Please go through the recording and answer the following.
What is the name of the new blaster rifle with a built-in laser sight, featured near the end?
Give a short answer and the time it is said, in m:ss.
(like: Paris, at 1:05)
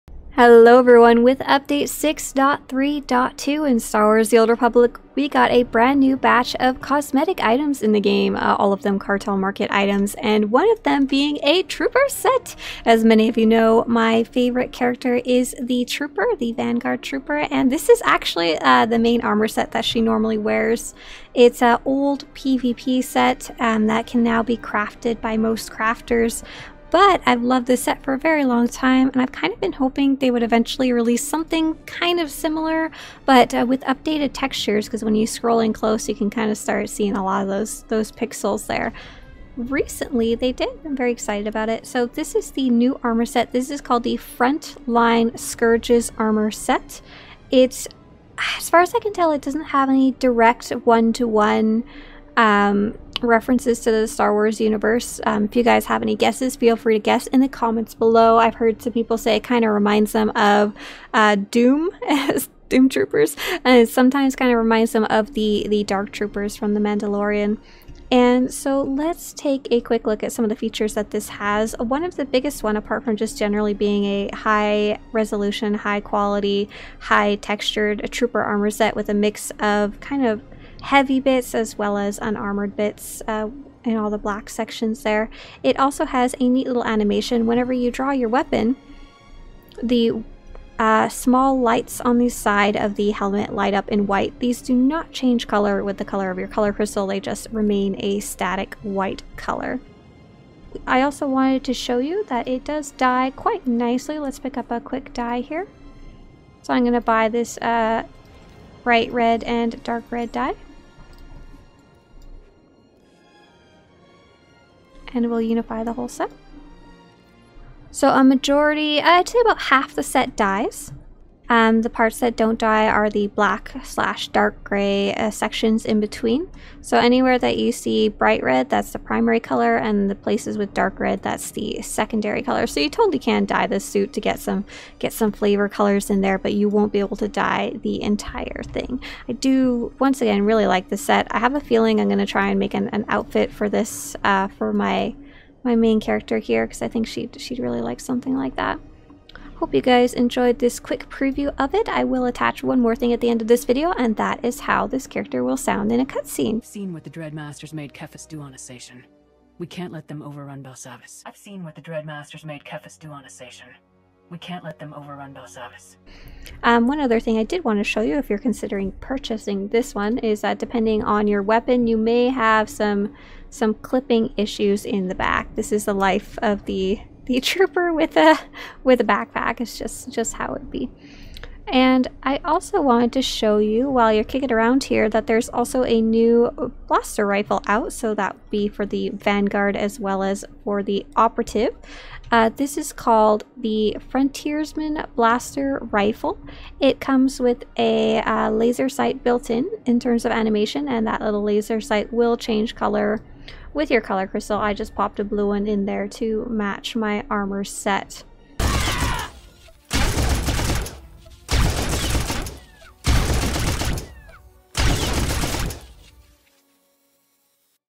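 Frontiersman Blaster Rifle, at 3:14.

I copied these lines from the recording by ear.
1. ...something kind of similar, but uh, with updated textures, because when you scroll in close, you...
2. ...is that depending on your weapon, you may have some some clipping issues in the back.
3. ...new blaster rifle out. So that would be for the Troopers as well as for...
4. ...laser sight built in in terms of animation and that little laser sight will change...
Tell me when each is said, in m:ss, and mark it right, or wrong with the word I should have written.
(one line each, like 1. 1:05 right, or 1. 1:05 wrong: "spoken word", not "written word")
1. 0:31 right
2. 2:50 right
3. 3:06 wrong: "Vanguard", not "Troopers"
4. 3:18 right.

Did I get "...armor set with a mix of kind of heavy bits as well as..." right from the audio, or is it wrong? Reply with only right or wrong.
right.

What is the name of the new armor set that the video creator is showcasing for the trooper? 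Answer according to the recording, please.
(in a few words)
Frontline Scourges.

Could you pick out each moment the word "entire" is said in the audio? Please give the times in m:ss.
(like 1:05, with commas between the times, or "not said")
2:18.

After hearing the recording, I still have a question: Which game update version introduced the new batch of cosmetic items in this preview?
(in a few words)
6.3.2.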